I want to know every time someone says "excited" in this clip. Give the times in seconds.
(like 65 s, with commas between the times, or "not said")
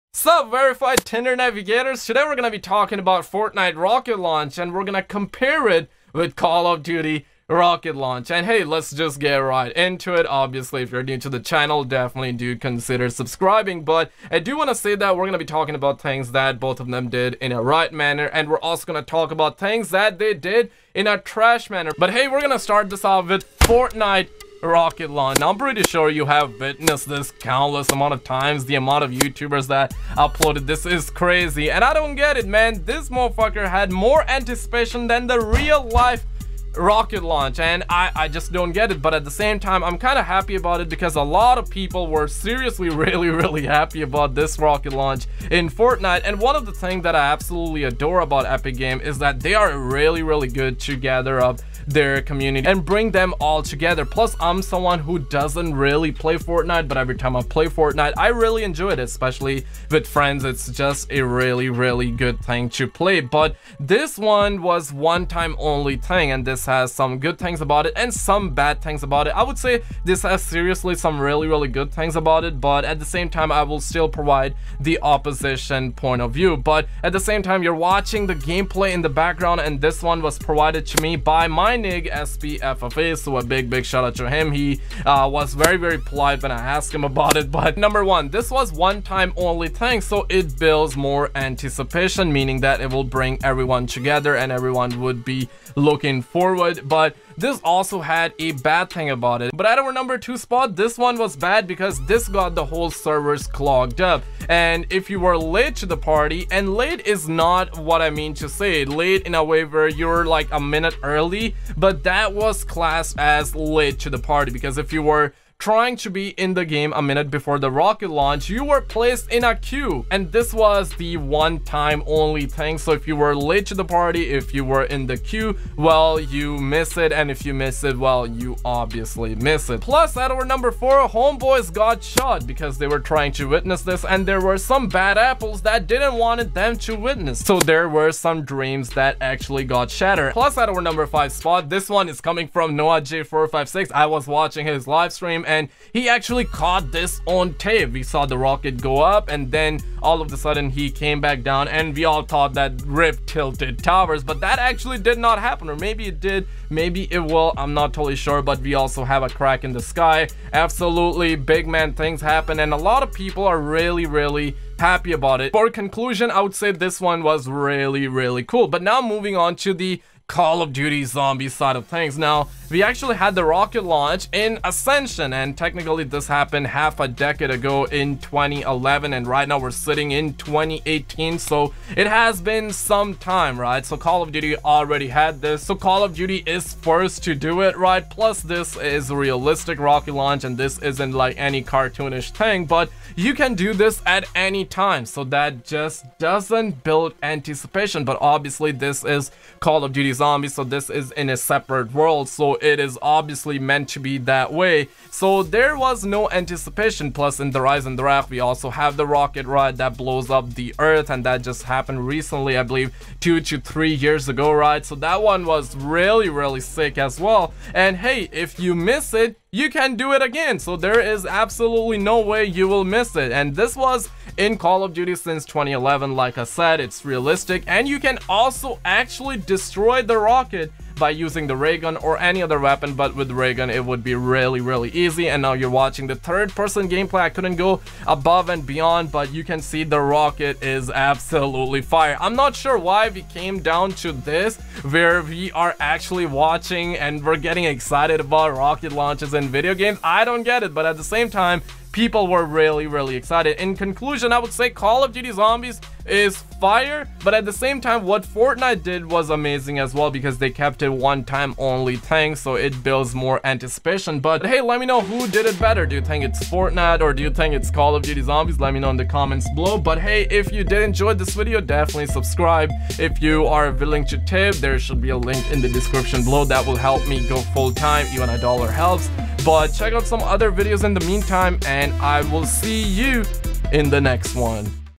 247 s, 253 s.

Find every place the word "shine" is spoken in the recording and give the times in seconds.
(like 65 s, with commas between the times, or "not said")
not said.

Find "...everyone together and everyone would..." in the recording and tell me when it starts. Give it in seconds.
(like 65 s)
93 s.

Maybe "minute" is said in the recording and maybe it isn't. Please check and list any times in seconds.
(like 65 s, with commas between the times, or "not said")
110 s, 117 s.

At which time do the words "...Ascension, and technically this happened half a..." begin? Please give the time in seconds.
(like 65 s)
174 s.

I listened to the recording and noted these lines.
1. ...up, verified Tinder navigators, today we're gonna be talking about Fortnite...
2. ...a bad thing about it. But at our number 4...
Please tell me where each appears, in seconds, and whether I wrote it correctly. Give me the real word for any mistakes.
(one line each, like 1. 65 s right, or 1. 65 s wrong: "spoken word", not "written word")
1. 0 s right
2. 98 s wrong: "2", not "4".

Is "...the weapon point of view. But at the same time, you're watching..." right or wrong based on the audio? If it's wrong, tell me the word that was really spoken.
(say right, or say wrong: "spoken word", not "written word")
wrong: "opposition", not "weapon".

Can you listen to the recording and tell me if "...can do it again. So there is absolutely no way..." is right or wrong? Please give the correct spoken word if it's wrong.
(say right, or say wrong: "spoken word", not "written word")
right.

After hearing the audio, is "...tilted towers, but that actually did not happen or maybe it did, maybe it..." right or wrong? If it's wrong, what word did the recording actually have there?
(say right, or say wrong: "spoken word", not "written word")
right.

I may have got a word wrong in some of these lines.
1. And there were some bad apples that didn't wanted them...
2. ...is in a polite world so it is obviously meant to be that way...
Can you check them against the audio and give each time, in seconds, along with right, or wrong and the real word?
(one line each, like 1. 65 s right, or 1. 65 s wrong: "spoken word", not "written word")
1. 134 s right
2. 200 s wrong: "separate", not "polite".